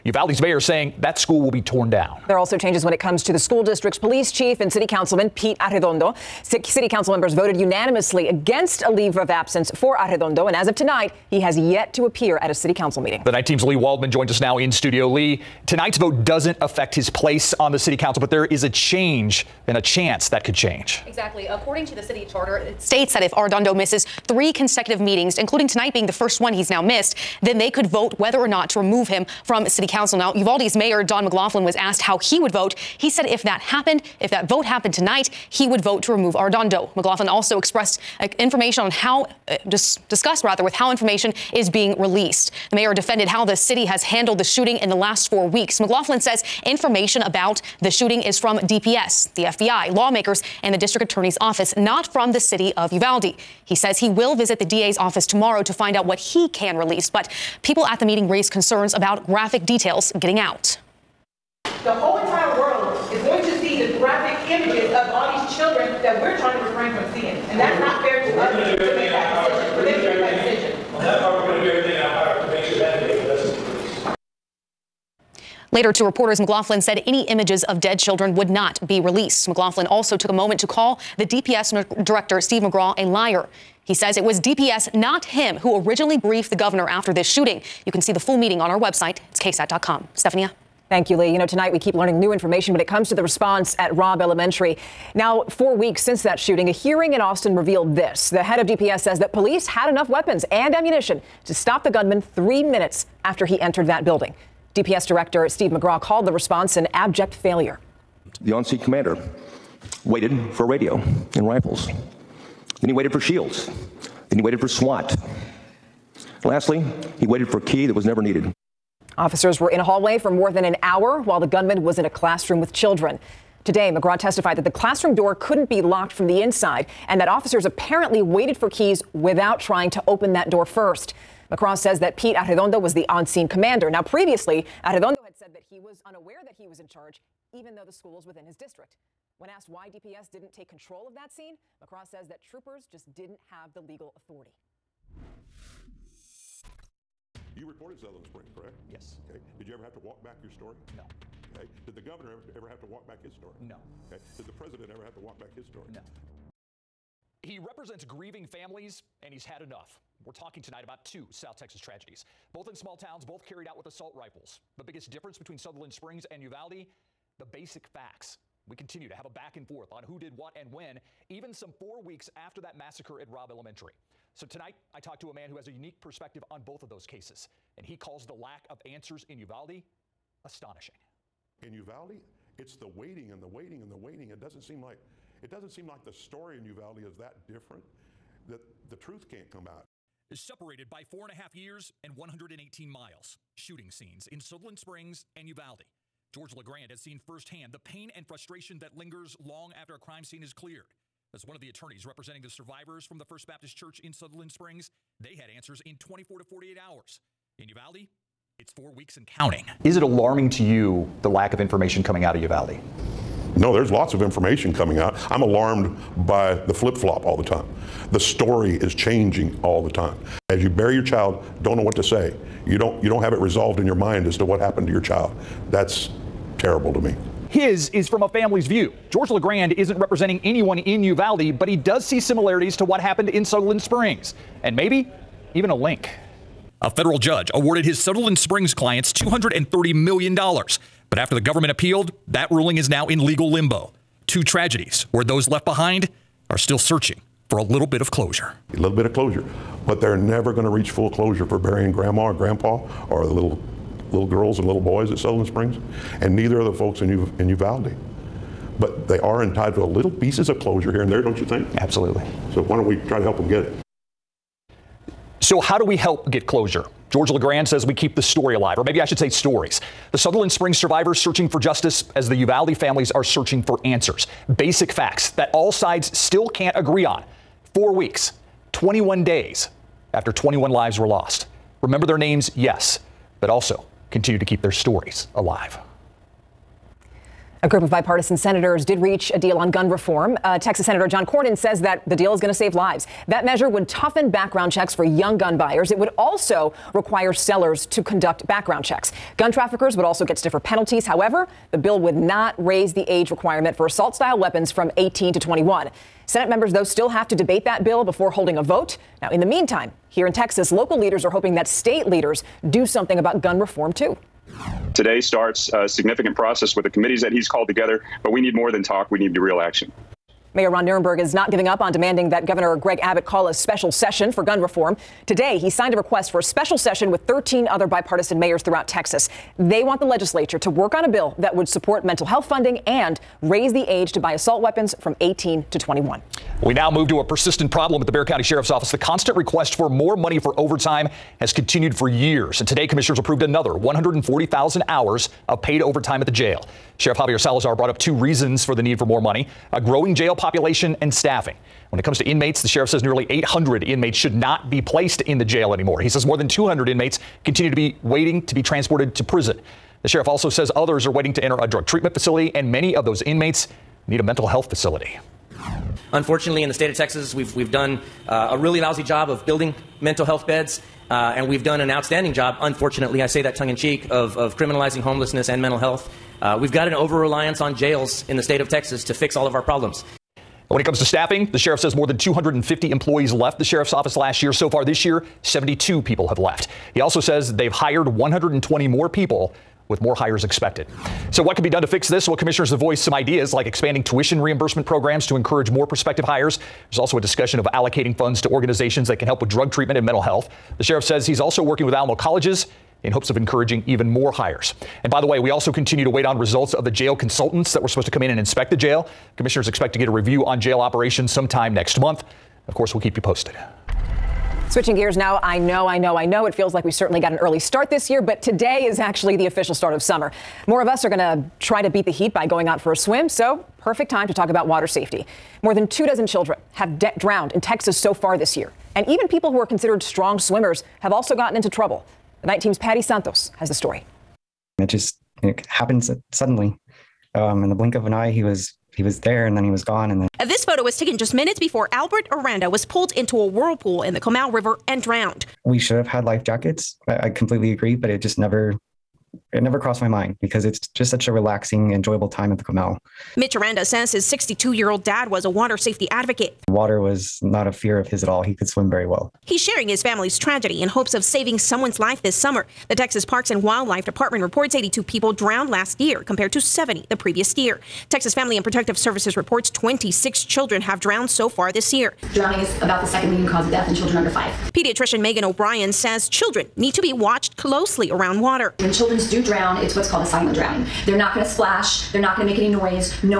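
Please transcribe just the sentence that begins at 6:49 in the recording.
Commissioners expect to get a review on jail operations sometime next month.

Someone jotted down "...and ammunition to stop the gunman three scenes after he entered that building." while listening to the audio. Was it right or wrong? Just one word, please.
wrong.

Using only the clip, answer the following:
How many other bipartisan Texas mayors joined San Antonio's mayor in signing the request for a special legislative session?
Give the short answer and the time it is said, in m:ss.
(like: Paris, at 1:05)
13, at 5:27.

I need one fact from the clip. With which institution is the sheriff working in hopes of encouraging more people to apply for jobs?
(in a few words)
Alamo Colleges.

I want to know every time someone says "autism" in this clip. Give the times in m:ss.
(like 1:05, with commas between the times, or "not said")
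not said.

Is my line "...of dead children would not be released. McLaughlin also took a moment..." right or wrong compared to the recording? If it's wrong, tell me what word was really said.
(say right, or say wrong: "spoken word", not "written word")
right.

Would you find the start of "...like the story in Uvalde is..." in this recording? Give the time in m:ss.
3:05.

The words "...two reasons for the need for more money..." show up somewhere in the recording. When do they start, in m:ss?
5:47.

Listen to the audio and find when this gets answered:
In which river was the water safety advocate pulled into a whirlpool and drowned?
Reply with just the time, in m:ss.
7:24.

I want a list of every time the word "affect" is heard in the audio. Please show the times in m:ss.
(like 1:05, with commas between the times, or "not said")
0:16.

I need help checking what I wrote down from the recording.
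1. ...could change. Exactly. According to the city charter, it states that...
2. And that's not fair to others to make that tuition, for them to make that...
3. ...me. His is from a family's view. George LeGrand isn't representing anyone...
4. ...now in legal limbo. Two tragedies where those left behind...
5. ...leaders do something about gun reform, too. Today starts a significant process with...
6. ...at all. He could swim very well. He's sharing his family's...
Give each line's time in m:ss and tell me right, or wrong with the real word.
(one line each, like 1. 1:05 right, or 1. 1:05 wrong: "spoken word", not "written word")
1. 0:20 right
2. 1:07 wrong: "decision", not "tuition"
3. 3:47 right
4. 4:02 right
5. 5:12 right
6. 7:38 right.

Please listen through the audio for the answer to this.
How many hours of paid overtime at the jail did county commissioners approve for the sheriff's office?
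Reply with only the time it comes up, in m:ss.
5:43.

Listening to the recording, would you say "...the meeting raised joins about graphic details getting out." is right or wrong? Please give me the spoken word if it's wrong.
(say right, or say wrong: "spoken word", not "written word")
wrong: "concerns", not "joins".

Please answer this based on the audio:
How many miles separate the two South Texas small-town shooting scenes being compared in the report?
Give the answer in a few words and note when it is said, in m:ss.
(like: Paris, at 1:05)
118, at 3:12.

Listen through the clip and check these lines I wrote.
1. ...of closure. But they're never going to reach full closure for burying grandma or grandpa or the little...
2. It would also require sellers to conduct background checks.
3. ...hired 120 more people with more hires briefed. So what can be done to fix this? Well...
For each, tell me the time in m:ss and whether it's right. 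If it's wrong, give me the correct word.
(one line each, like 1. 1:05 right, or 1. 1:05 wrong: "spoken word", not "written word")
1. 4:09 right
2. 4:55 right
3. 6:27 wrong: "expected", not "briefed".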